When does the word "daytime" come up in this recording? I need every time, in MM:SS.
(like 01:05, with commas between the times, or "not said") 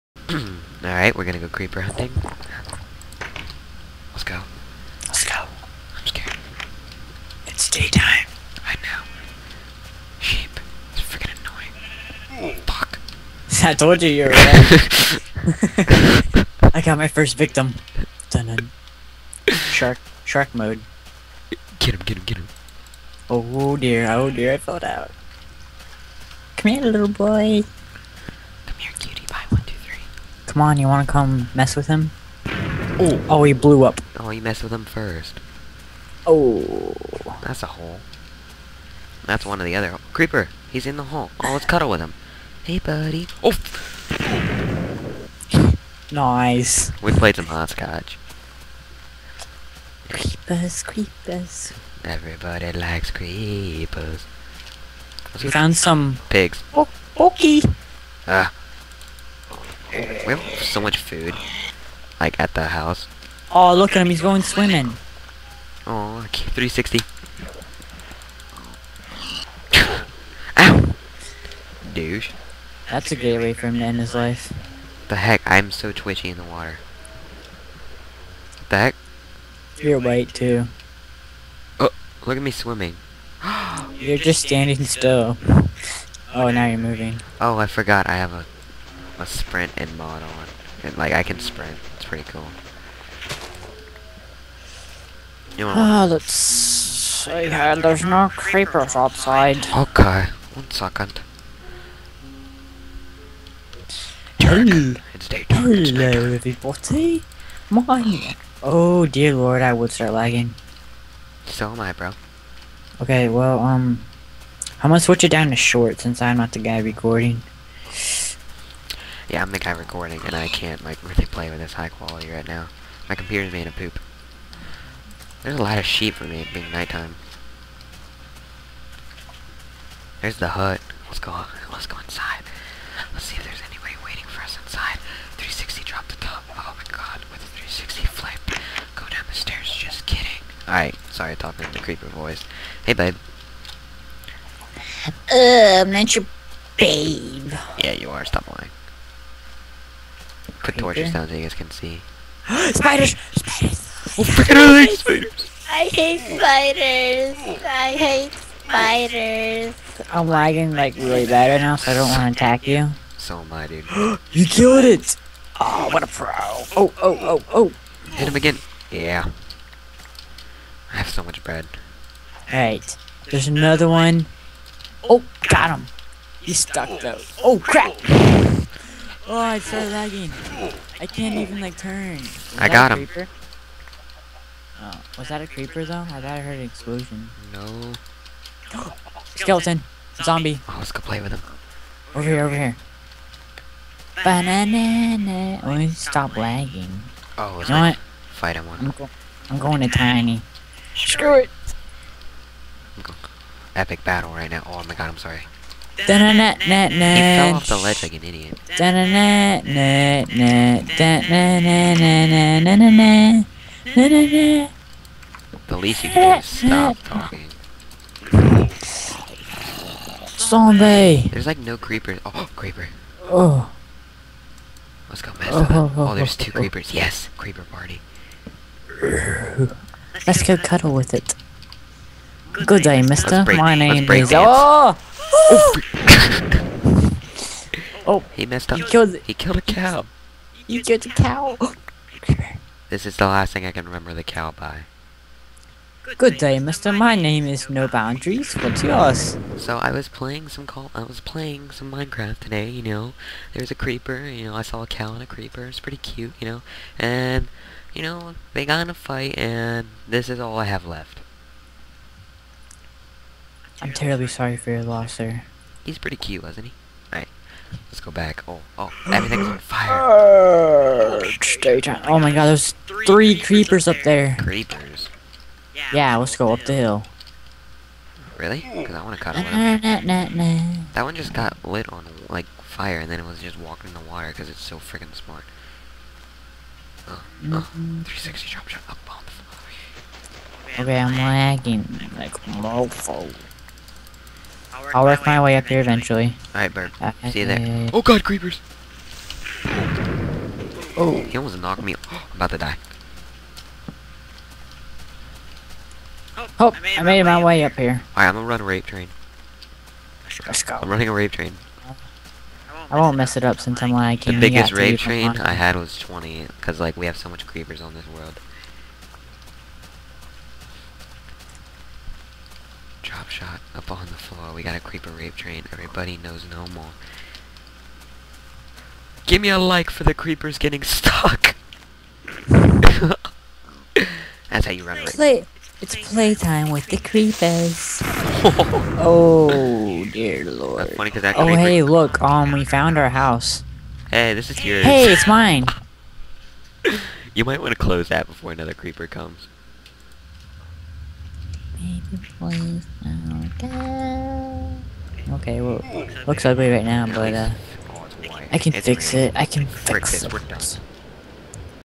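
00:07, 01:45.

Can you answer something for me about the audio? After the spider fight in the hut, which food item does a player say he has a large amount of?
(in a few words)
Bread.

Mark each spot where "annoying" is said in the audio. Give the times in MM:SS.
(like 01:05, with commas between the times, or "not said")
00:11.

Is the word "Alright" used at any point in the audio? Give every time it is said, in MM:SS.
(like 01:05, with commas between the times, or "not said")
00:00, 02:20, 02:52, 04:27, 04:56, 05:08.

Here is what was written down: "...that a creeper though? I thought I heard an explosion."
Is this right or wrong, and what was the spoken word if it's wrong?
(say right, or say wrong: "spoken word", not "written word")
right.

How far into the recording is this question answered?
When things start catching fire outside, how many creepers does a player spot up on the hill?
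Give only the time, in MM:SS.
04:33.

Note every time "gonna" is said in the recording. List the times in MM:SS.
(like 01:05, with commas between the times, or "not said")
00:01, 01:54, 05:08.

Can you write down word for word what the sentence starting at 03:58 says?
He killed, he killed a cow.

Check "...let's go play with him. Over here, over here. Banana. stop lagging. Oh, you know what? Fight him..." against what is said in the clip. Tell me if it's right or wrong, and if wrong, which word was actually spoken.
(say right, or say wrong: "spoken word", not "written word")
right.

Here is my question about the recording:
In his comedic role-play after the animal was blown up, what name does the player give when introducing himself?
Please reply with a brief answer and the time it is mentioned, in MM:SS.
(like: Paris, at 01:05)
No Boundaries, at 04:07.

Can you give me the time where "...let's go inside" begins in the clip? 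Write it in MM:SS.
02:11.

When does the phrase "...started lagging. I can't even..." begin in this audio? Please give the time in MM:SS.
02:59.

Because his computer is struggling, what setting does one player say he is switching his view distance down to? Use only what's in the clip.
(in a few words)
Short.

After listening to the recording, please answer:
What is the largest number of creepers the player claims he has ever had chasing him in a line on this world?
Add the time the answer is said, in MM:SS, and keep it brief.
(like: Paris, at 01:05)
20, at 05:15.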